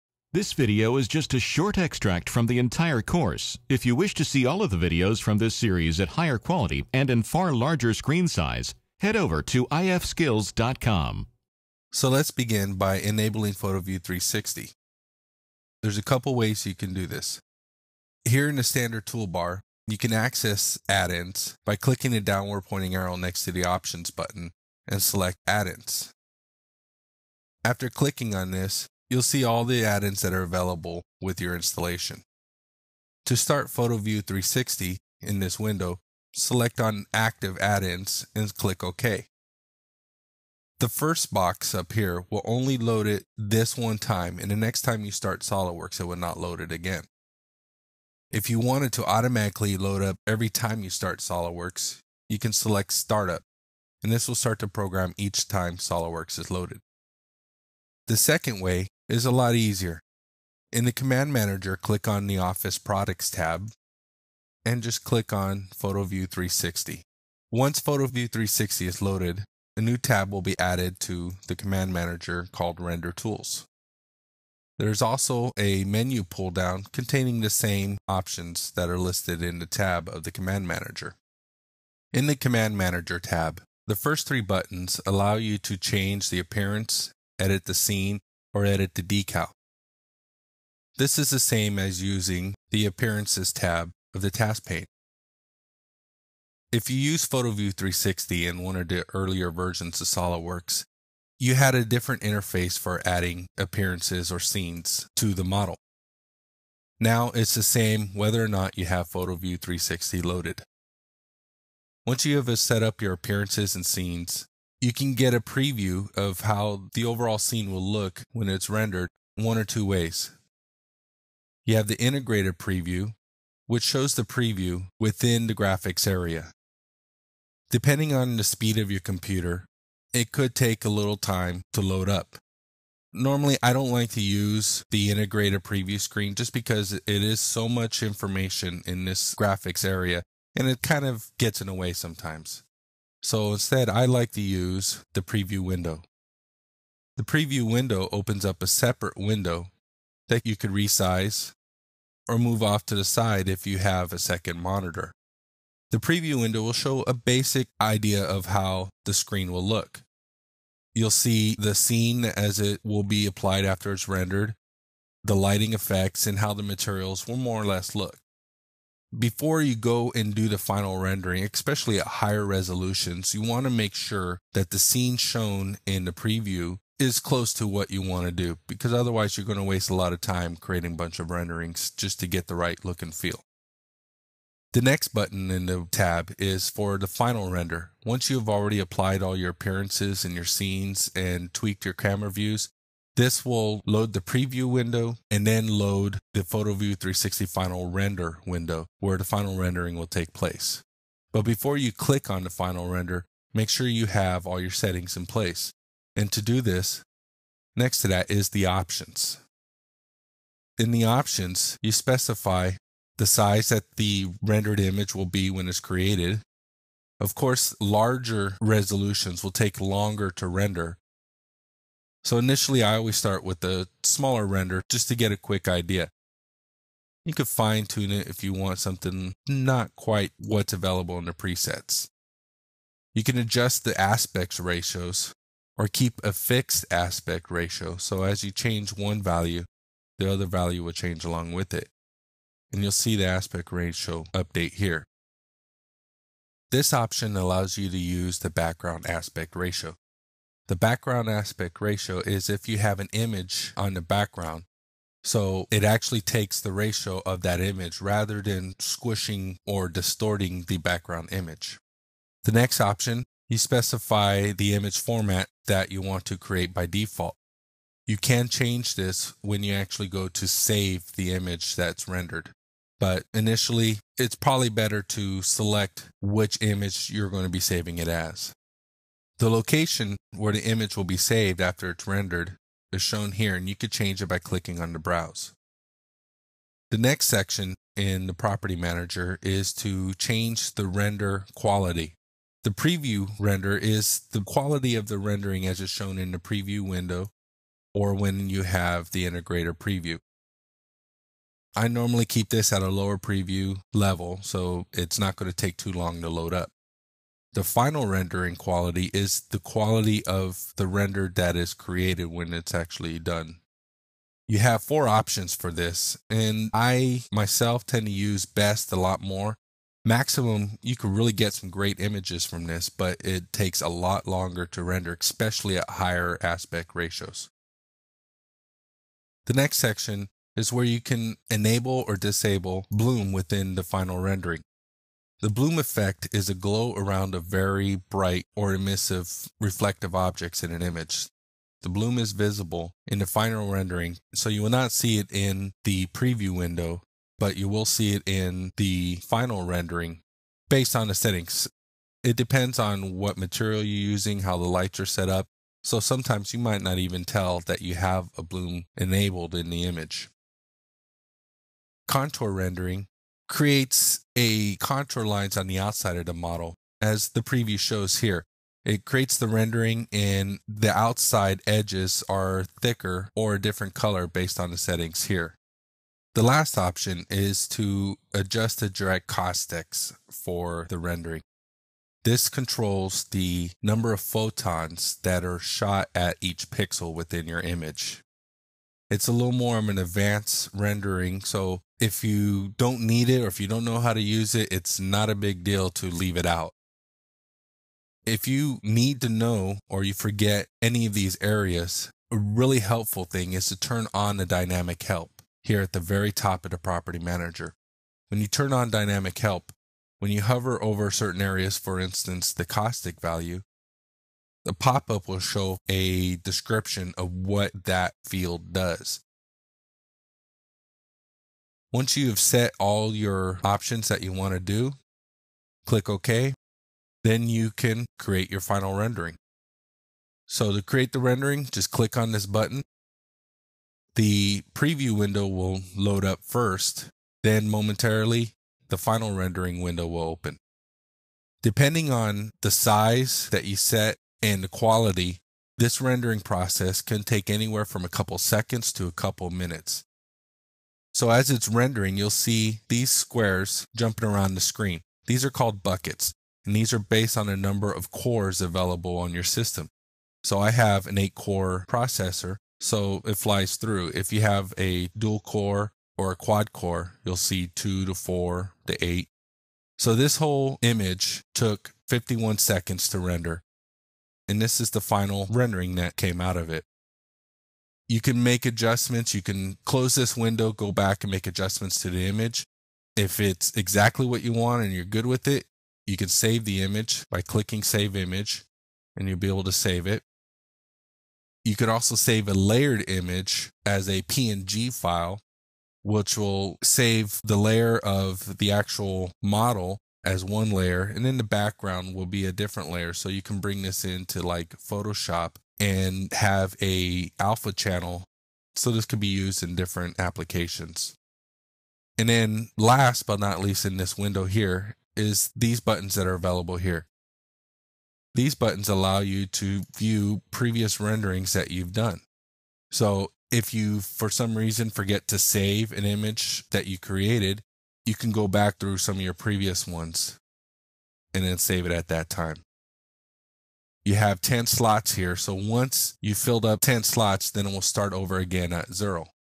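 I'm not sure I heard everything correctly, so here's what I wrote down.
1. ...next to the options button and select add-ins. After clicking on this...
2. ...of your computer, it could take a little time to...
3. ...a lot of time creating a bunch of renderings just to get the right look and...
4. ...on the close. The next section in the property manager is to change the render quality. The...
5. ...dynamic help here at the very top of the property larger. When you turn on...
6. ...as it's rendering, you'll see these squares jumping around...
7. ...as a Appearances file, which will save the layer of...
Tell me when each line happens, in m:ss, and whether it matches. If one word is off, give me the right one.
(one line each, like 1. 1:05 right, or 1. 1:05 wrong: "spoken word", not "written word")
1. 0:23 right
2. 2:08 right
3. 2:59 right
4. 4:44 wrong: "browse", not "close"
5. 6:44 wrong: "manager", not "larger"
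6. 7:31 right
7. 8:13 wrong: "PNG", not "Appearances".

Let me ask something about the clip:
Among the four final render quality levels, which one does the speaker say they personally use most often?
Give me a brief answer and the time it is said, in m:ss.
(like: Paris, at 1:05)
best, at 5:18.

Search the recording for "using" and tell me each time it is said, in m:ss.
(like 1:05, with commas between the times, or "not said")
1:32, 5:54.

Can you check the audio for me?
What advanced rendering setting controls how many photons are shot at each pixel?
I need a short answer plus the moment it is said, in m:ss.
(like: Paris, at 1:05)
direct caustics, at 6:18.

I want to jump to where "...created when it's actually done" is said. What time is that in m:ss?
5:11.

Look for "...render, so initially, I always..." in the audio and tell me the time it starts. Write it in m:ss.
3:40.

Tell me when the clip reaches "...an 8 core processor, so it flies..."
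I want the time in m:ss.
7:41.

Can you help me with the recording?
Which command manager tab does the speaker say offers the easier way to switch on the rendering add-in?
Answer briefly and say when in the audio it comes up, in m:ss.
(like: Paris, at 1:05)
Office Products, at 1:02.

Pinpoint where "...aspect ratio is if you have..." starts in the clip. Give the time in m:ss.
4:11.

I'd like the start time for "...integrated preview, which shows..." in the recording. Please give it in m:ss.
2:02.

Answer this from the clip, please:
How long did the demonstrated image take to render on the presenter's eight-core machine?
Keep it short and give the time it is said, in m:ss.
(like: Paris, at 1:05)
51 seconds, at 7:52.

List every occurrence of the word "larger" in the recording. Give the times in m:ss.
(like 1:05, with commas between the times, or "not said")
0:07, 3:37.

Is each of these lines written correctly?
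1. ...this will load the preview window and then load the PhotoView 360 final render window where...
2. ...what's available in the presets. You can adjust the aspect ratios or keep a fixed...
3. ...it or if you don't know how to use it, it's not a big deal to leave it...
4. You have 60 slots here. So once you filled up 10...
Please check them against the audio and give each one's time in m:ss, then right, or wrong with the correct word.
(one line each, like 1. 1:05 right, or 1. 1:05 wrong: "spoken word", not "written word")
1. 3:13 right
2. 3:50 right
3. 6:33 right
4. 8:54 wrong: "10", not "60".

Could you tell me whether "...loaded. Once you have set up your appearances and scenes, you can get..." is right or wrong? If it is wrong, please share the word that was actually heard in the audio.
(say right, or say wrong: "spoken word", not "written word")
right.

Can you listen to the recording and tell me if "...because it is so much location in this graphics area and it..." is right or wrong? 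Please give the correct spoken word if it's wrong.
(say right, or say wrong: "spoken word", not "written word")
wrong: "information", not "location".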